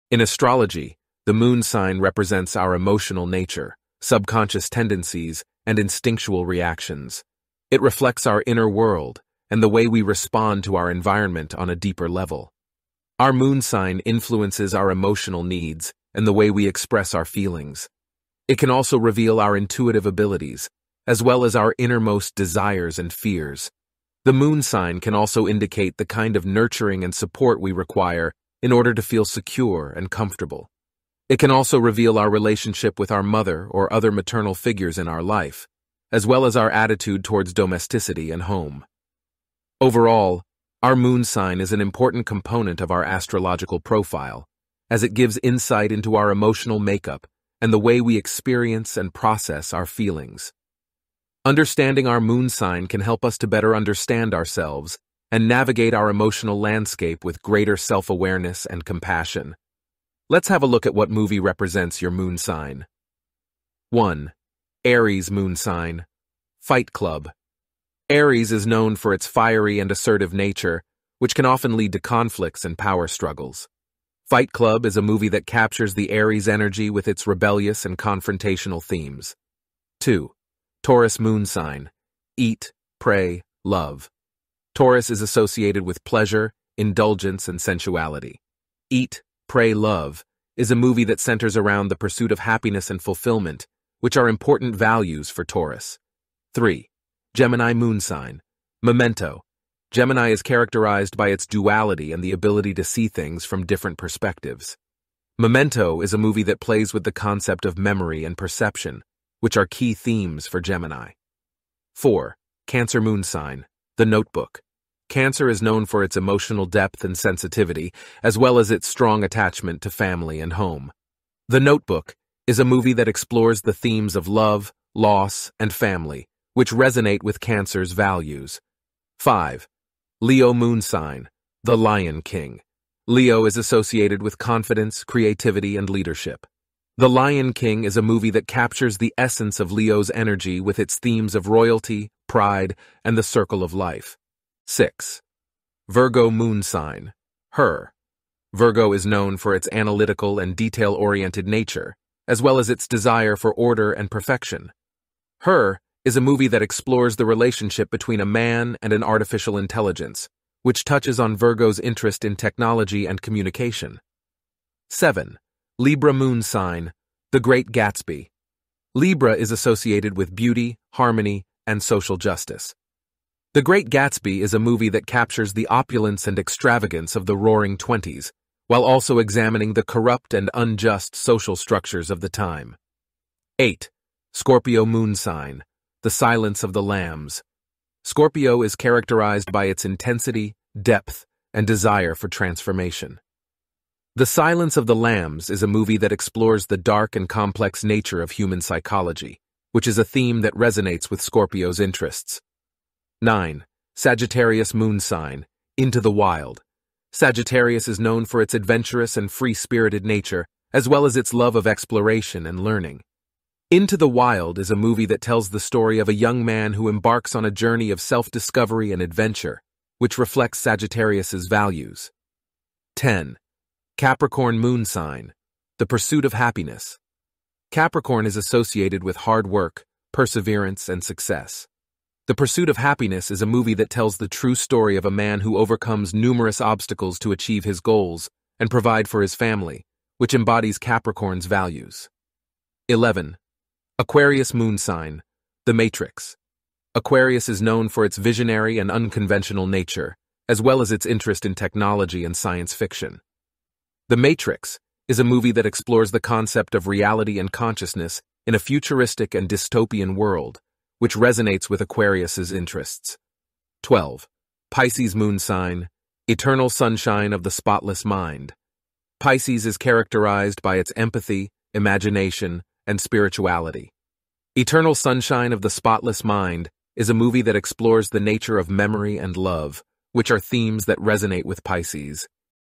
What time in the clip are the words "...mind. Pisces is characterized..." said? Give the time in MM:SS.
04:28.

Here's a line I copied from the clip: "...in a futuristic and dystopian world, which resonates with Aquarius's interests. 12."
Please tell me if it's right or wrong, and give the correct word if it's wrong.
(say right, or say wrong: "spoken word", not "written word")
right.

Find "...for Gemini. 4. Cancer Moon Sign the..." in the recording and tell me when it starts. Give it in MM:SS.
01:50.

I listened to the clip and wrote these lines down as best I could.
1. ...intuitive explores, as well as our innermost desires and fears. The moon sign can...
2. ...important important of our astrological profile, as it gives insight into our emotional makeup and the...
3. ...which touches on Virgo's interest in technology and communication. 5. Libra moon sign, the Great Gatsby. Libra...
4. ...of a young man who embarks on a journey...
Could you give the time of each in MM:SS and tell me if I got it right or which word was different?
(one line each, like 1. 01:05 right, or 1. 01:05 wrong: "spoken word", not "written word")
1. 00:19 wrong: "abilities", not "explores"
2. 00:41 wrong: "component", not "important"
3. 02:40 wrong: "7", not "5"
4. 03:35 right.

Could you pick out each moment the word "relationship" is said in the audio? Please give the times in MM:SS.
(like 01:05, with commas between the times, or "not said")
00:32, 02:37.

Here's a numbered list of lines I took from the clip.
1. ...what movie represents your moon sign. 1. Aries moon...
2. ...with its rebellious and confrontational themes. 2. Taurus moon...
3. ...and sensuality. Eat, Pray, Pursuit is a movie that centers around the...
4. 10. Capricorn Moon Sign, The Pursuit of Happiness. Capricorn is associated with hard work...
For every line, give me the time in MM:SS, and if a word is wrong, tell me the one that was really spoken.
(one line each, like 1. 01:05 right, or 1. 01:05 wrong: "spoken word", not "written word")
1. 01:00 right
2. 01:16 right
3. 01:27 wrong: "Love", not "Pursuit"
4. 03:42 right.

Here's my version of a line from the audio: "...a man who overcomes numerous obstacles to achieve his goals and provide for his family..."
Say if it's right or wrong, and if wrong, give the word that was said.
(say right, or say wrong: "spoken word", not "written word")
right.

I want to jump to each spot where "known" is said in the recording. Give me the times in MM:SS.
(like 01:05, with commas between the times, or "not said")
01:08, 01:55, 02:29, 03:27, 04:07.